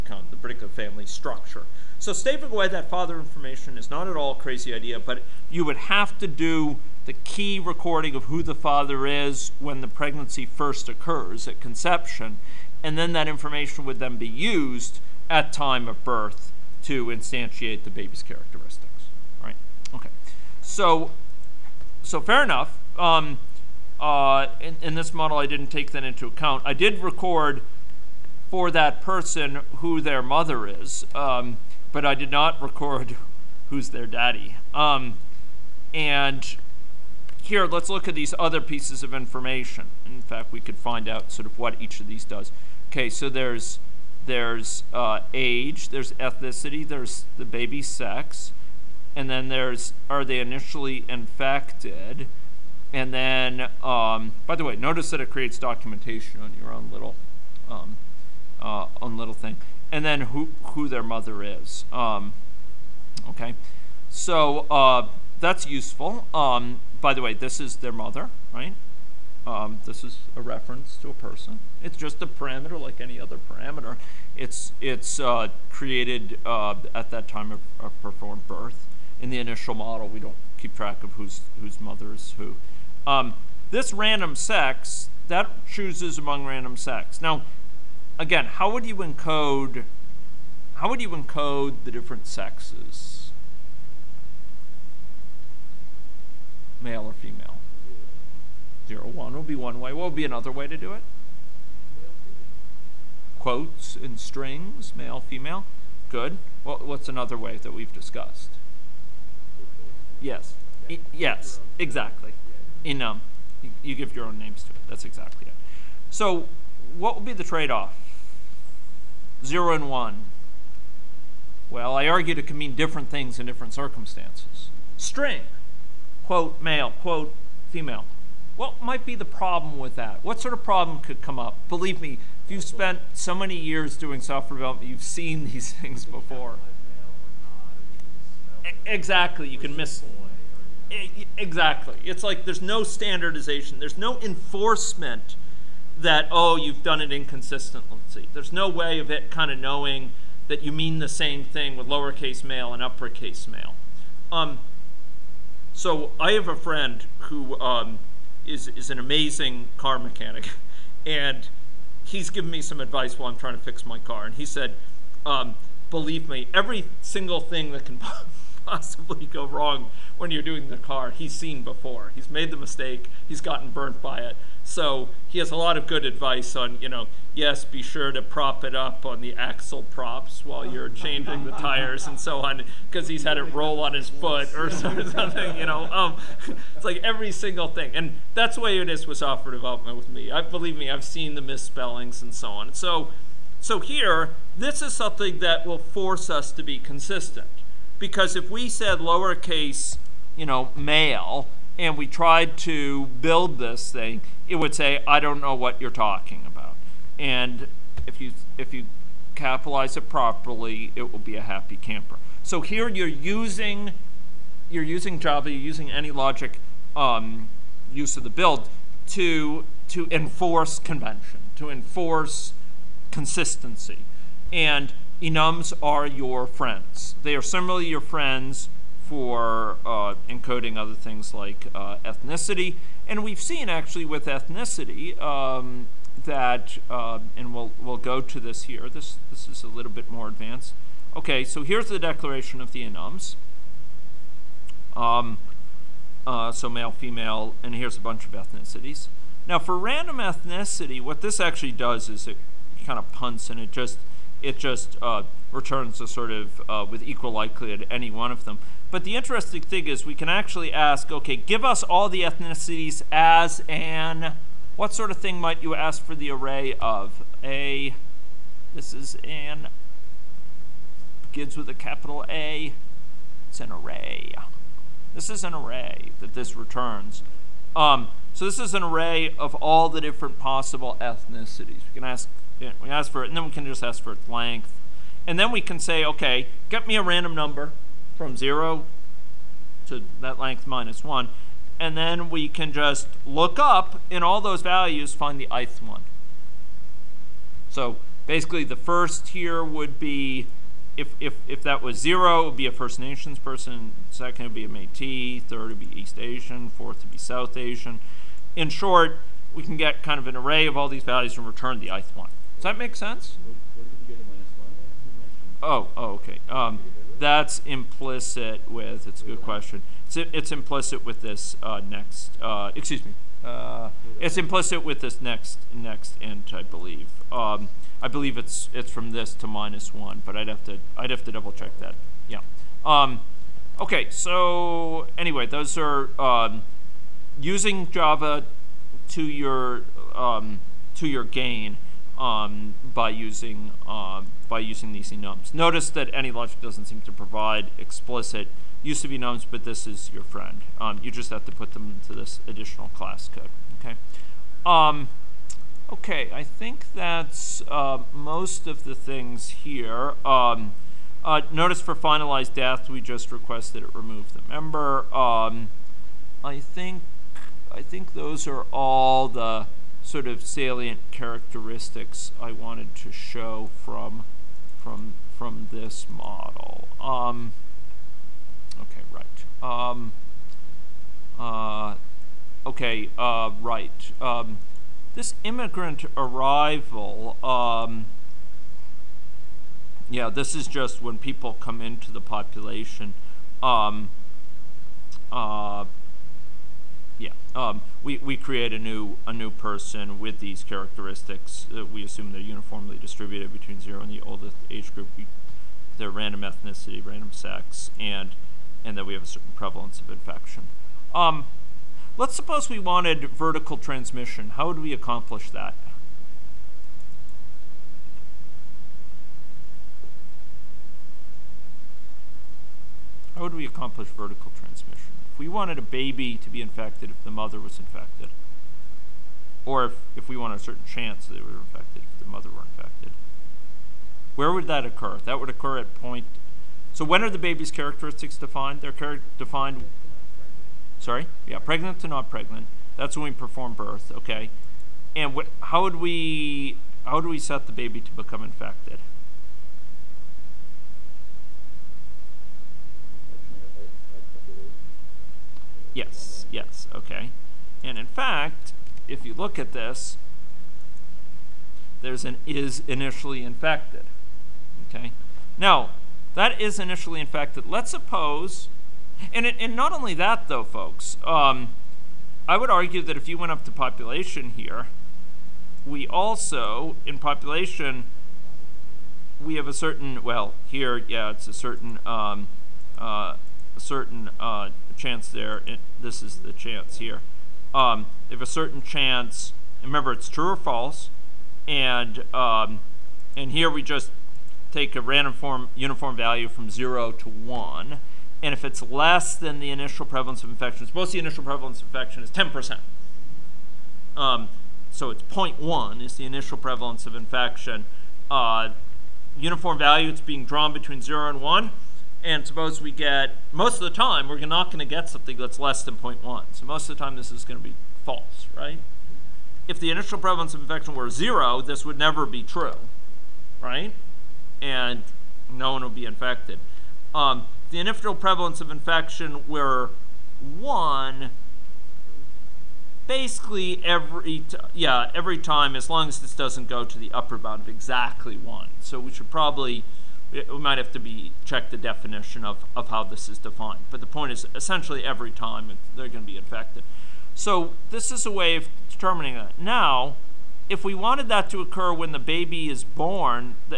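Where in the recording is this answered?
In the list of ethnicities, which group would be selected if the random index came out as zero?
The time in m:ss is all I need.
5:02.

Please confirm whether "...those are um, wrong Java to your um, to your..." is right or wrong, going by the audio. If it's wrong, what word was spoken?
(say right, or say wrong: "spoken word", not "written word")
wrong: "using", not "wrong".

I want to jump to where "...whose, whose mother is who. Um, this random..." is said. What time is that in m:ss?
1:21.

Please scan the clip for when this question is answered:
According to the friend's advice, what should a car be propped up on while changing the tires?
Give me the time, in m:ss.
2:59.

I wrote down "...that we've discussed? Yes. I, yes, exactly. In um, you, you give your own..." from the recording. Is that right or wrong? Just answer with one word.
right.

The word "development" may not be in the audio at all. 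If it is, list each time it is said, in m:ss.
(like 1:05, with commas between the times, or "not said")
2:14, 3:09.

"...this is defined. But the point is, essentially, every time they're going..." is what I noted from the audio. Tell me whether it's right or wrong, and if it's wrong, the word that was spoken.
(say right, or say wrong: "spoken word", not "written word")
right.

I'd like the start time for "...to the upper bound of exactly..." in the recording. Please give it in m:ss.
8:56.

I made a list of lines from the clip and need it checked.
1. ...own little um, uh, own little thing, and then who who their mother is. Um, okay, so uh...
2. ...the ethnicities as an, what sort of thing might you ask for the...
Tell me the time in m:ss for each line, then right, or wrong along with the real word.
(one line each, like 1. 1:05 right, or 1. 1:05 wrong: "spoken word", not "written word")
1. 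0:56 right
2. 4:22 right.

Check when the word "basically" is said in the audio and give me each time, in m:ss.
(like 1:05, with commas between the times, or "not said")
4:58, 8:53.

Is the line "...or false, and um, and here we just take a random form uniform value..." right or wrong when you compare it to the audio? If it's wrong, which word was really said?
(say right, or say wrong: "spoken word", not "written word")
right.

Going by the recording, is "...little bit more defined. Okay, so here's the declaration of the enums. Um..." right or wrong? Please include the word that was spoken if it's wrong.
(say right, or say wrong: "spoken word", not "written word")
wrong: "advanced", not "defined".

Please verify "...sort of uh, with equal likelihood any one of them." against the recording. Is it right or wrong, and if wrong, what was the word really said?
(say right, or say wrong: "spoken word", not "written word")
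right.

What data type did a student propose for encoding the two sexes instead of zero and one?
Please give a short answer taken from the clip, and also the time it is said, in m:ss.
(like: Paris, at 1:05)
Strings, at 1:43.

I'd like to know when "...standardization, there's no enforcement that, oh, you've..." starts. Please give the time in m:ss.
2:22.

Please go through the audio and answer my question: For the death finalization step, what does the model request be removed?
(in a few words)
The member.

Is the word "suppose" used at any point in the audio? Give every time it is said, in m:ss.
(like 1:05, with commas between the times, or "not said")
6:52, 7:47, 8:20, 8:32.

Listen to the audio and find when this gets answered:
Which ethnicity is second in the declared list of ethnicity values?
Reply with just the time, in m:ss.
5:04.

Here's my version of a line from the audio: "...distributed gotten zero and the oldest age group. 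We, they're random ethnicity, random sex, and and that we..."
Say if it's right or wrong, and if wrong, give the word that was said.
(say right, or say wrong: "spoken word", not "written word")
wrong: "between", not "gotten".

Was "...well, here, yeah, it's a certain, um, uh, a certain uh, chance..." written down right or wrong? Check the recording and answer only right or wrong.
right.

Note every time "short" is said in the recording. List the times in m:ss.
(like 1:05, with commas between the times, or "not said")
5:08.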